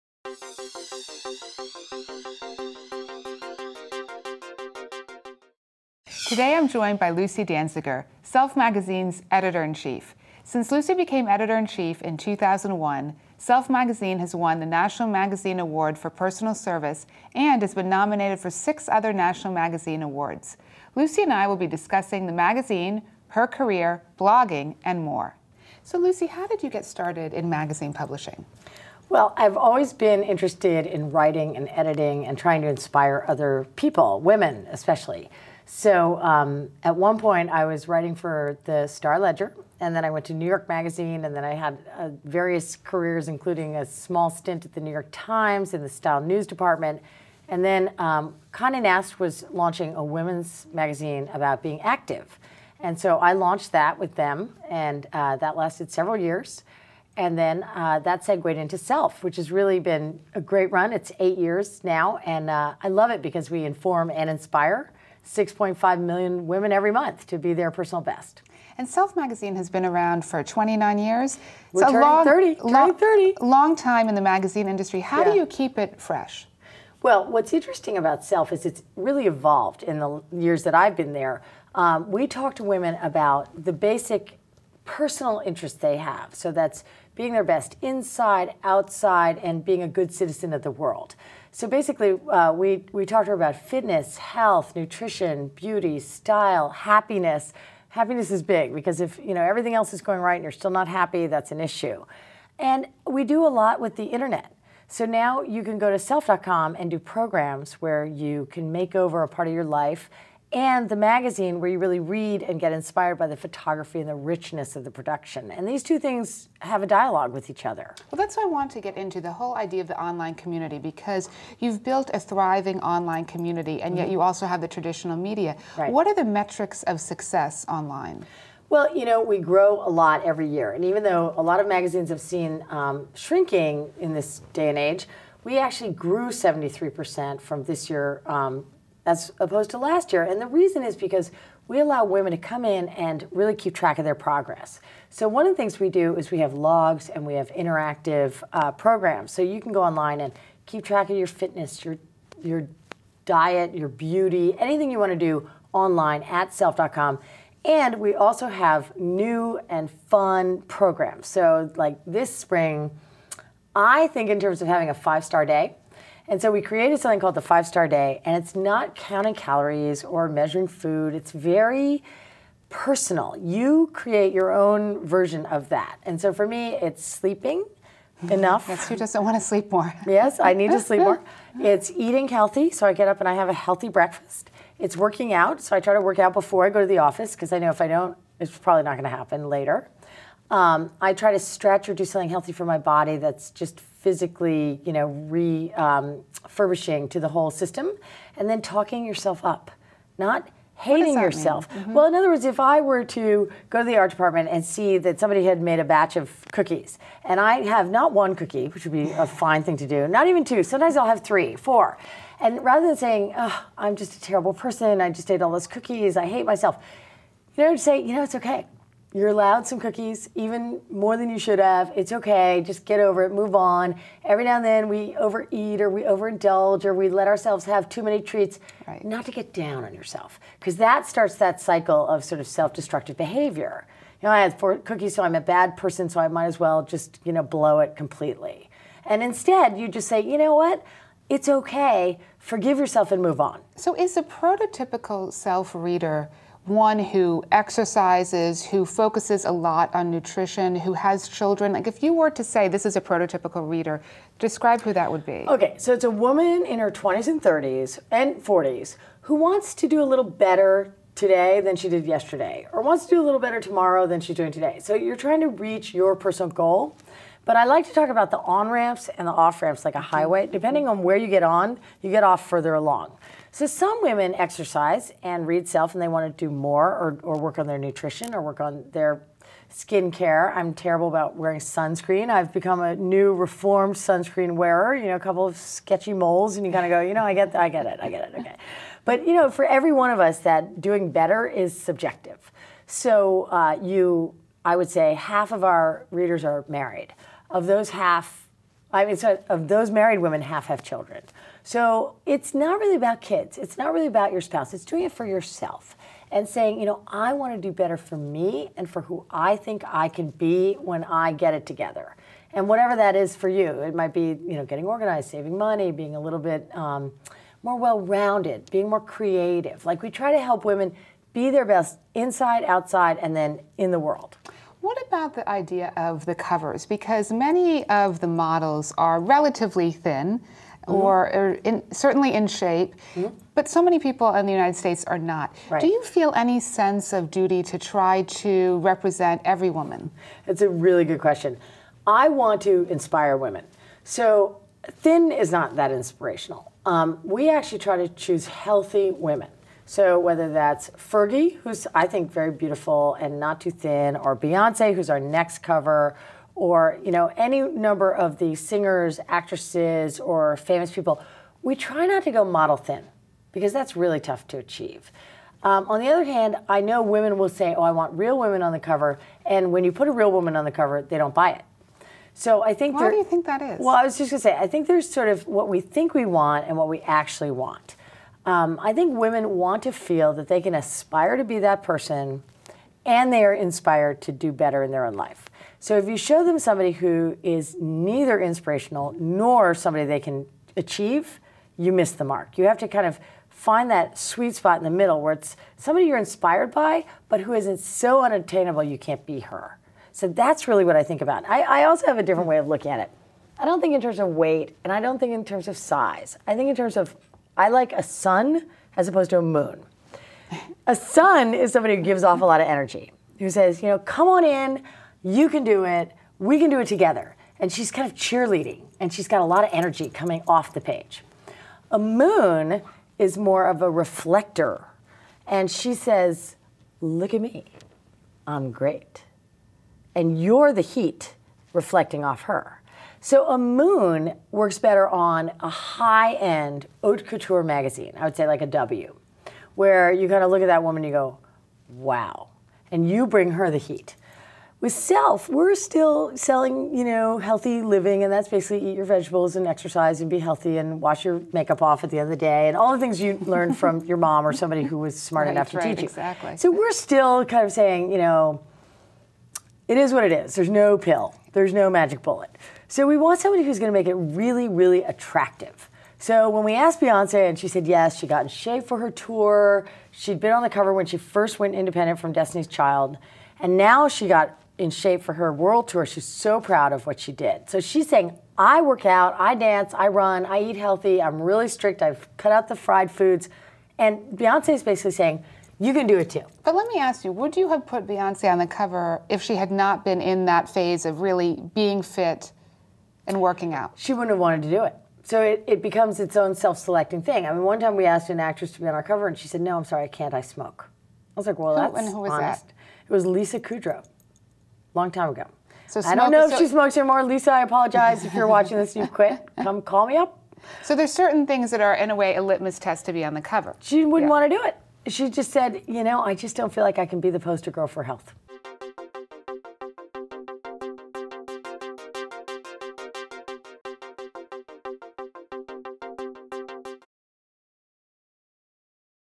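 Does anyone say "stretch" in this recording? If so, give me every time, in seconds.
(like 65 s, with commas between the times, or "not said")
191 s.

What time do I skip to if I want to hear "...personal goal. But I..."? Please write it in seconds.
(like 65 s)
266 s.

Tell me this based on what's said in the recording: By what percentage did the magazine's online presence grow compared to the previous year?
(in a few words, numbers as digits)
73%.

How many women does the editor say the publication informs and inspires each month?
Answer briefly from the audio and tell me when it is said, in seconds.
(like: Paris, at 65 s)
6.5 million, at 65 s.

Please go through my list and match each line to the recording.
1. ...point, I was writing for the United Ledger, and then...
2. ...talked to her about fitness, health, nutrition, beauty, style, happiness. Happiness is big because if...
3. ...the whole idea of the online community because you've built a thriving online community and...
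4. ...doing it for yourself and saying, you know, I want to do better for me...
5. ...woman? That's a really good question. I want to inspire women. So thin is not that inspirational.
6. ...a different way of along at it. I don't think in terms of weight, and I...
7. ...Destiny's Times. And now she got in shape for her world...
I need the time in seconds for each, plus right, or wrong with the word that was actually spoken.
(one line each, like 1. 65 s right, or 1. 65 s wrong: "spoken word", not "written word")
1. 37 s wrong: "Star", not "United"
2. 93 s right
3. 119 s right
4. 304 s right
5. 339 s right
6. 402 s wrong: "looking", not "along"
7. 472 s wrong: "Child", not "Times".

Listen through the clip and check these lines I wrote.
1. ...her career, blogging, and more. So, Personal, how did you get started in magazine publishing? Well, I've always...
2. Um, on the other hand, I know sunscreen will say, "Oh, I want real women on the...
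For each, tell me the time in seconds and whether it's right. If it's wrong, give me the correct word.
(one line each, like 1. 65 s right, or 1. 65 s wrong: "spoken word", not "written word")
1. 23 s wrong: "Lucy", not "Personal"
2. 365 s wrong: "women", not "sunscreen".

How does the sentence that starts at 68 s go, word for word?
And Self Magazine has been around for 29 years.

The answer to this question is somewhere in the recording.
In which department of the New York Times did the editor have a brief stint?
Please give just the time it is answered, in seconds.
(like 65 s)
45 s.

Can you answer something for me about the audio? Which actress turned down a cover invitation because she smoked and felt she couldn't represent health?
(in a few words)
Lisa Kudrow.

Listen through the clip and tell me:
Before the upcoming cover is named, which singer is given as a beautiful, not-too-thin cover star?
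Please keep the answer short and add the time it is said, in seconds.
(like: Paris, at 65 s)
Fergie, at 350 s.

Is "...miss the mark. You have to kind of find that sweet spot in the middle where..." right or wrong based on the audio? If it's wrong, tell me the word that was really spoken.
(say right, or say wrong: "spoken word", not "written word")
right.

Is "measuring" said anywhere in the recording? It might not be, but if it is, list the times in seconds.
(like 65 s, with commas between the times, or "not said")
170 s.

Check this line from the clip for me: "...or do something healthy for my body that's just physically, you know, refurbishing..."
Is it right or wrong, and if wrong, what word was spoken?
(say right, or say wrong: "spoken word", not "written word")
right.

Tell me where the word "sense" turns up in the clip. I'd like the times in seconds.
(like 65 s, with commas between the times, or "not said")
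336 s.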